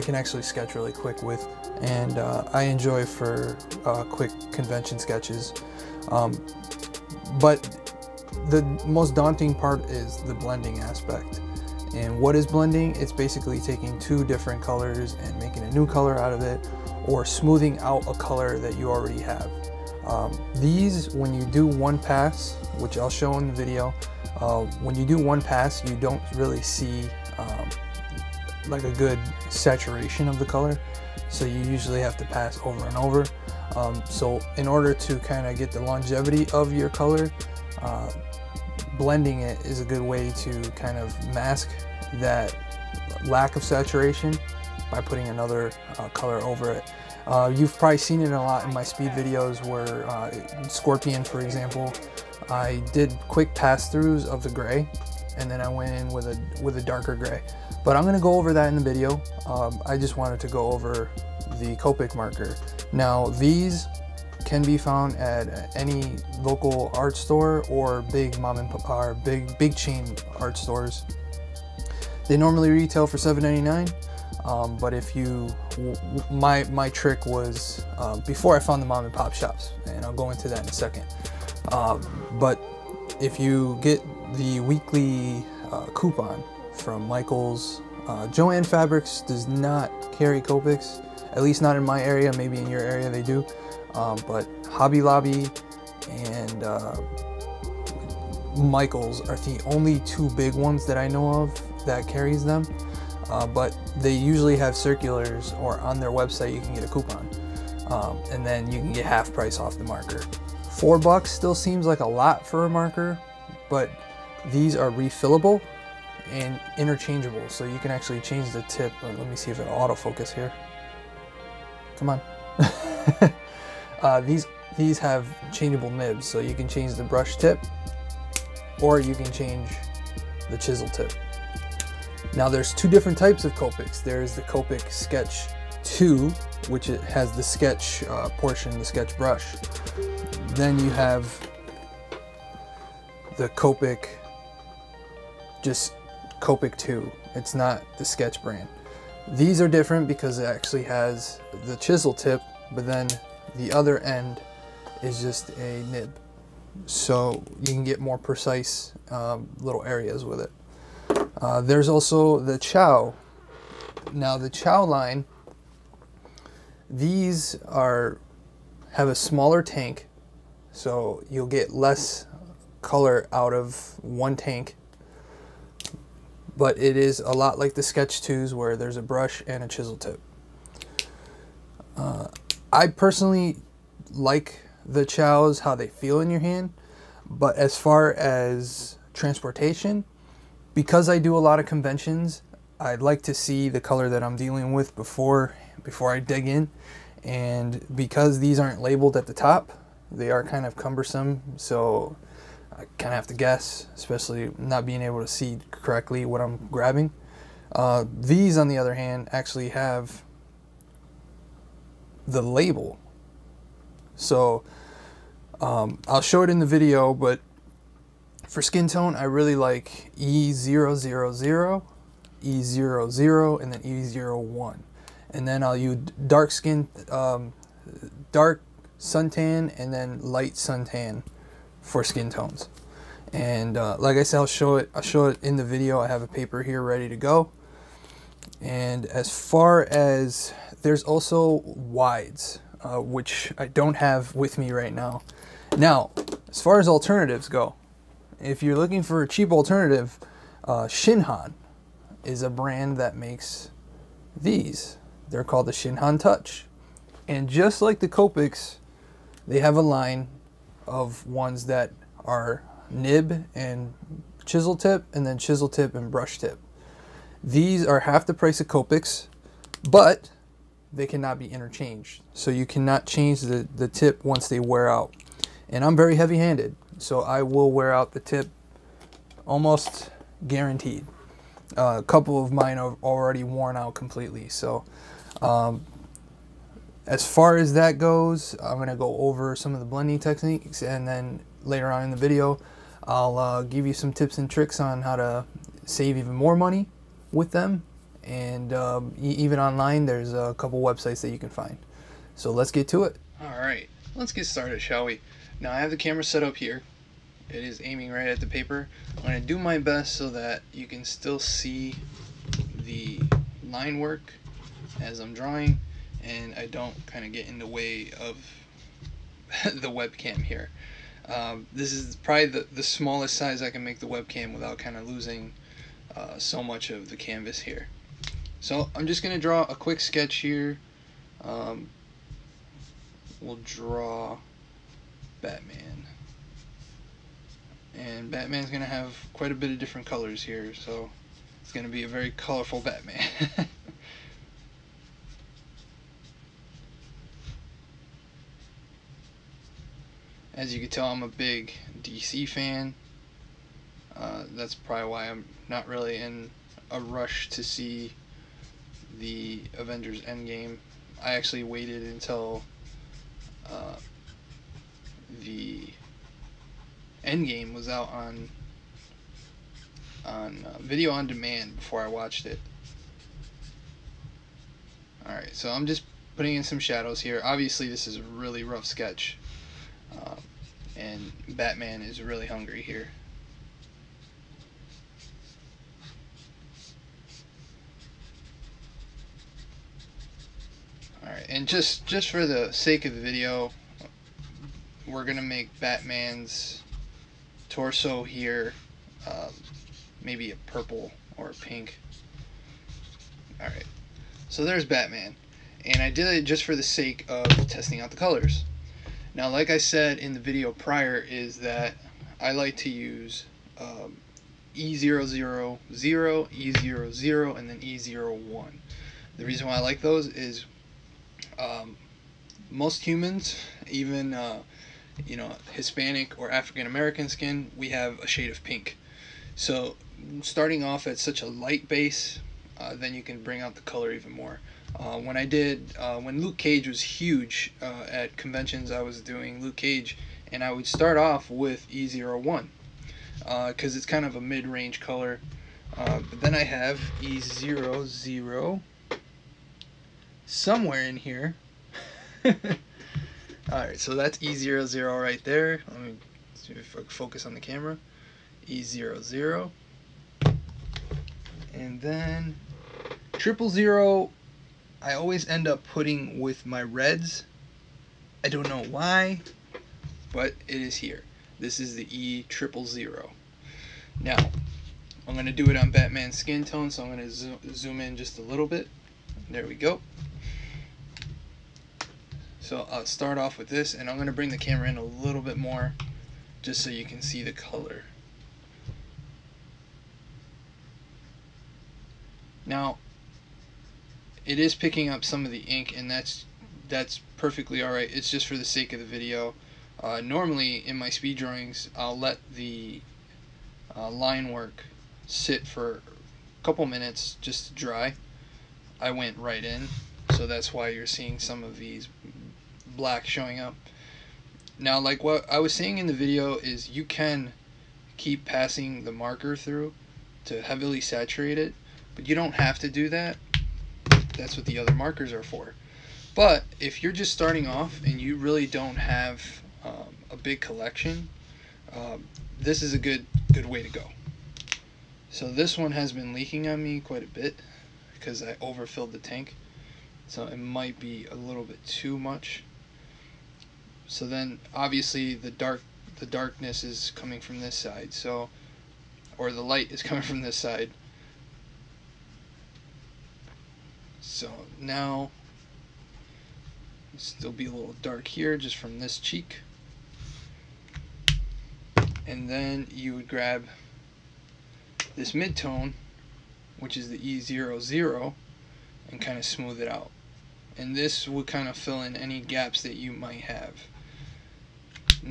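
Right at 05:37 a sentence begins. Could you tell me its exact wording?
And Batman's going to have quite a bit of different colors here, so it's going to be a very colorful Batman.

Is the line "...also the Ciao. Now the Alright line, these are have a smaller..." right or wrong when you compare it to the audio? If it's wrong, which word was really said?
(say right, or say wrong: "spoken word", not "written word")
wrong: "Ciao", not "Alright".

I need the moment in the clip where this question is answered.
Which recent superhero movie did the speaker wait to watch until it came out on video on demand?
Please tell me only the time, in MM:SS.
05:59.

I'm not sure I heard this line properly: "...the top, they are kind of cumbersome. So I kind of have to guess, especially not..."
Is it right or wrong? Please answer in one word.
right.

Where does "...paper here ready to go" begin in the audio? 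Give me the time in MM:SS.
03:56.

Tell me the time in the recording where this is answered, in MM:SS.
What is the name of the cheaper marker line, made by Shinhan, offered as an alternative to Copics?
04:15.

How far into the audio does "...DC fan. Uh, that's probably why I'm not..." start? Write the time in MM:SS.
05:52.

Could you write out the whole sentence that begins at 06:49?
Now, like I said in the video prior, is that I like to use um, E000, E00, and then E01.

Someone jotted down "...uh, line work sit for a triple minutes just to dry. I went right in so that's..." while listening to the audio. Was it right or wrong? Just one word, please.
wrong.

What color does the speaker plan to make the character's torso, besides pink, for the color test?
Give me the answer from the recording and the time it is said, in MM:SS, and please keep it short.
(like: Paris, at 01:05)
purple, at 06:40.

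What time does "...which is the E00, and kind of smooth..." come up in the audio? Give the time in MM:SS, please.
09:26.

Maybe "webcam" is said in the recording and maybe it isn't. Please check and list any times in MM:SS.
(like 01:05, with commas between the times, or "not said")
05:19, 05:24.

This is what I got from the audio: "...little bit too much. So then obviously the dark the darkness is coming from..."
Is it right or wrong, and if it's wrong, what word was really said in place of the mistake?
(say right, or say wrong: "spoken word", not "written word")
right.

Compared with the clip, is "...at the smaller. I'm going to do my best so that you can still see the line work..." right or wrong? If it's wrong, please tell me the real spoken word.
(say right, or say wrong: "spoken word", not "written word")
wrong: "paper", not "smaller".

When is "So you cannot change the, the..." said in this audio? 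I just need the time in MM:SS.
04:32.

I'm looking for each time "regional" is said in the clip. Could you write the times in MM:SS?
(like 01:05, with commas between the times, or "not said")
not said.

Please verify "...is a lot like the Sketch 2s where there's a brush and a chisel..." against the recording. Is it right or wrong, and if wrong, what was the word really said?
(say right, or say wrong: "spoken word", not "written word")
right.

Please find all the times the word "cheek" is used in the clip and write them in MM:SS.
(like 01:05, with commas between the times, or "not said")
09:19.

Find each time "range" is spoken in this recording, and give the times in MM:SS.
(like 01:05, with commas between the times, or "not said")
07:24.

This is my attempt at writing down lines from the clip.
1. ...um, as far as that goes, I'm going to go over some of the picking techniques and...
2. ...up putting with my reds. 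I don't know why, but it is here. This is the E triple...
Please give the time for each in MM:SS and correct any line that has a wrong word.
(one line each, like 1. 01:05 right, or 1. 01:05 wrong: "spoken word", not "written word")
1. 04:45 wrong: "blending", not "picking"
2. 07:45 right.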